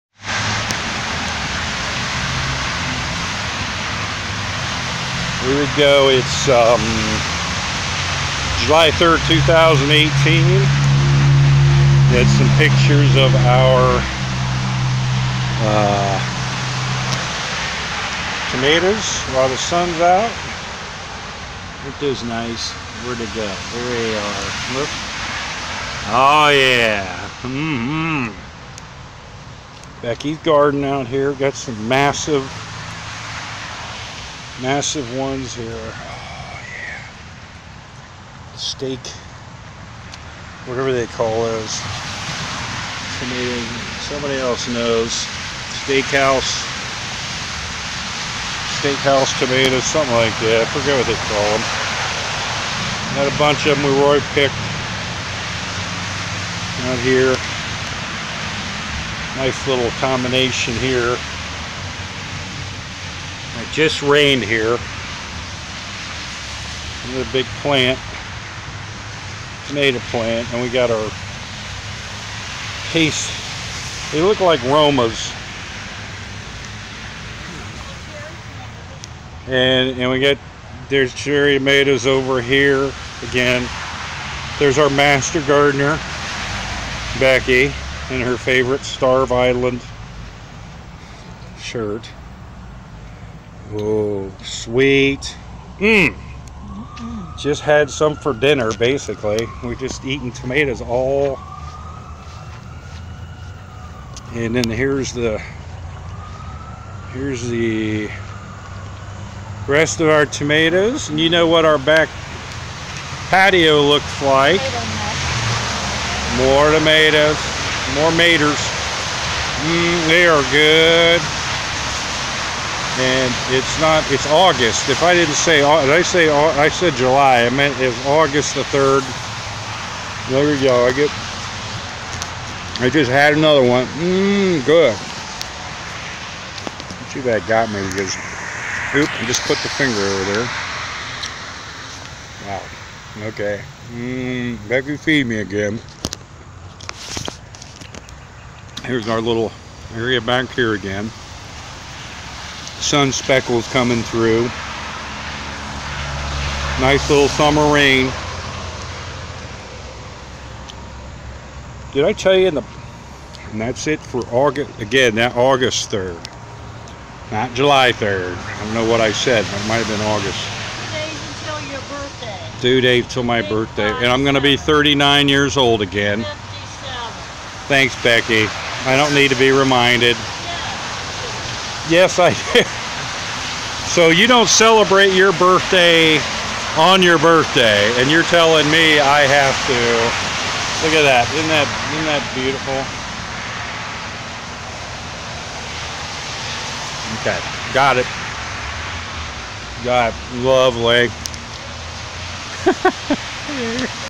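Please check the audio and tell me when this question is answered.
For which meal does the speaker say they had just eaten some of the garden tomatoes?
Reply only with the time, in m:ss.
1:38.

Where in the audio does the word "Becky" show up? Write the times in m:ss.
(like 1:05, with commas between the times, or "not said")
0:30, 1:27, 2:58.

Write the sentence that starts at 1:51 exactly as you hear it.
And you know what our back patio looks like.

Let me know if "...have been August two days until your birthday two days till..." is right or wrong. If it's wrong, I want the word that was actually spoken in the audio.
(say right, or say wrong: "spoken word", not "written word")
right.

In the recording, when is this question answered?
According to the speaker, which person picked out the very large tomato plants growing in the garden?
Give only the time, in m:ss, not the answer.
0:53.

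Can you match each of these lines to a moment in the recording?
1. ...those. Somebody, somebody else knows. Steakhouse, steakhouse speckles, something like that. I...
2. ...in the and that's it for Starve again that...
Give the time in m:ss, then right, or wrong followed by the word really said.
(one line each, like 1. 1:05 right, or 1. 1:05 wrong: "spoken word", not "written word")
1. 0:41 wrong: "tomatoes", not "speckles"
2. 2:42 wrong: "August", not "Starve".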